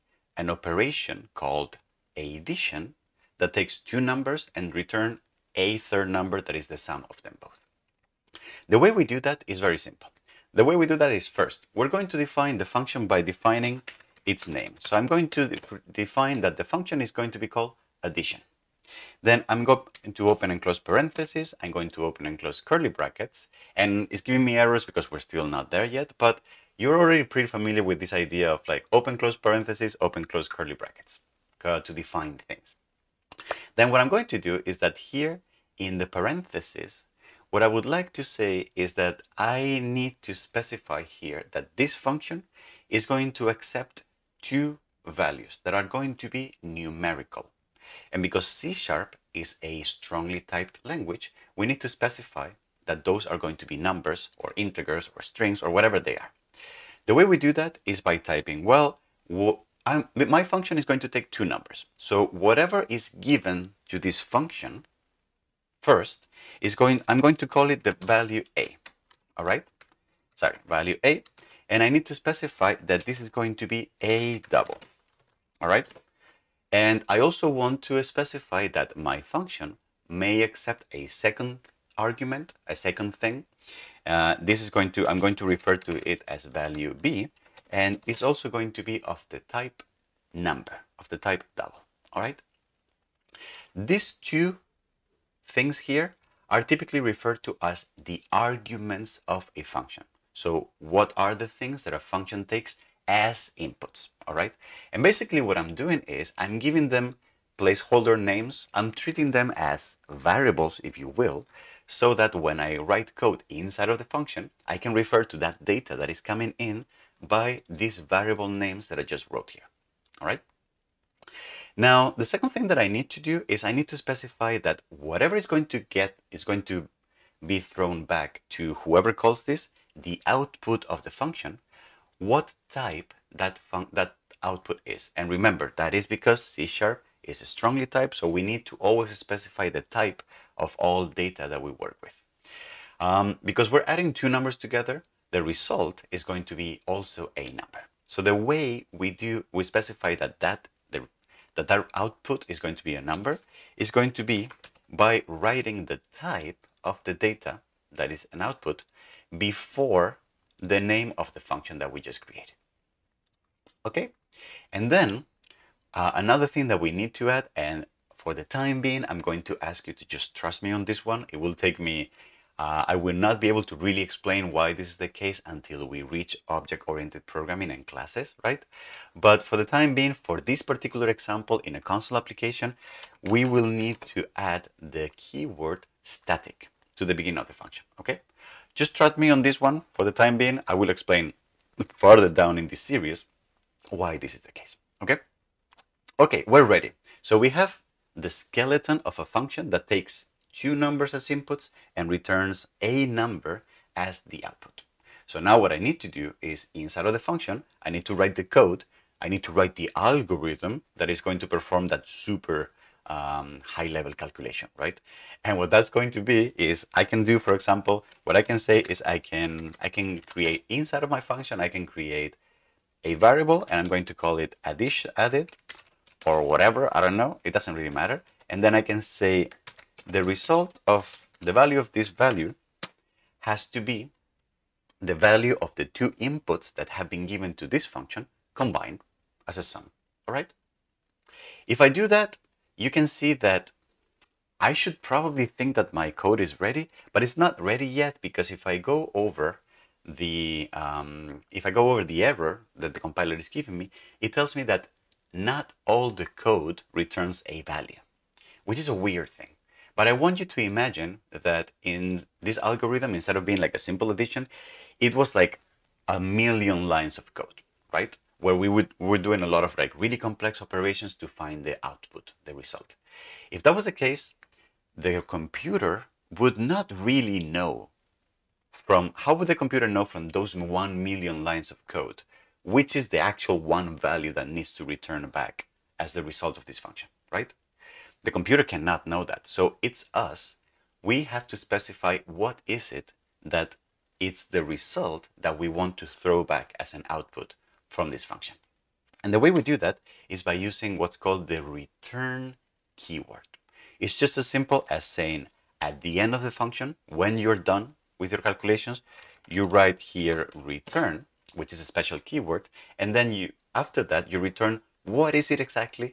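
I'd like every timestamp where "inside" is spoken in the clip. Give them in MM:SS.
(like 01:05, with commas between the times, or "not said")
01:53, 03:26, 03:40.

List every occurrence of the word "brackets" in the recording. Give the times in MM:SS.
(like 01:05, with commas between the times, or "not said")
00:22, 00:30.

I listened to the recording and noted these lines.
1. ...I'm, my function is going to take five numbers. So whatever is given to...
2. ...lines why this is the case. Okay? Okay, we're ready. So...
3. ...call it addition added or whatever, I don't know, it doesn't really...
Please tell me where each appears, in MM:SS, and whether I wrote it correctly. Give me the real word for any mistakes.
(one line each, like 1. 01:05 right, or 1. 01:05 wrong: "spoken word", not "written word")
1. 00:59 wrong: "two", not "five"
2. 03:12 wrong: "series", not "lines"
3. 03:44 right.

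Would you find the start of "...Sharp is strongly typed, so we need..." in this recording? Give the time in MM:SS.
02:16.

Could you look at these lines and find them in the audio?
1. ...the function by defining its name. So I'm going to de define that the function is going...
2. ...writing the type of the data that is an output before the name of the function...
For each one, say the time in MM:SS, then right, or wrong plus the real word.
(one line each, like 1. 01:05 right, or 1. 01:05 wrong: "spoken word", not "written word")
1. 00:12 right
2. 02:35 right.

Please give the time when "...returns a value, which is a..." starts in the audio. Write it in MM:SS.
04:16.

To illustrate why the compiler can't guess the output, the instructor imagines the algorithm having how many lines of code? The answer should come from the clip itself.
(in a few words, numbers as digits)
1 million.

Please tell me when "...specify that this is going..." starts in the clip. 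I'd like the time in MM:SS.
01:12.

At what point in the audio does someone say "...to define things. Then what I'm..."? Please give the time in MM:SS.
00:31.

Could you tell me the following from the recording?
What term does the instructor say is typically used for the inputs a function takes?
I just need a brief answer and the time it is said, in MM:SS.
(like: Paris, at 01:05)
arguments, at 01:33.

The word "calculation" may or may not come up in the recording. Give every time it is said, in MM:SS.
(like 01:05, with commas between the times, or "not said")
03:34, 05:08.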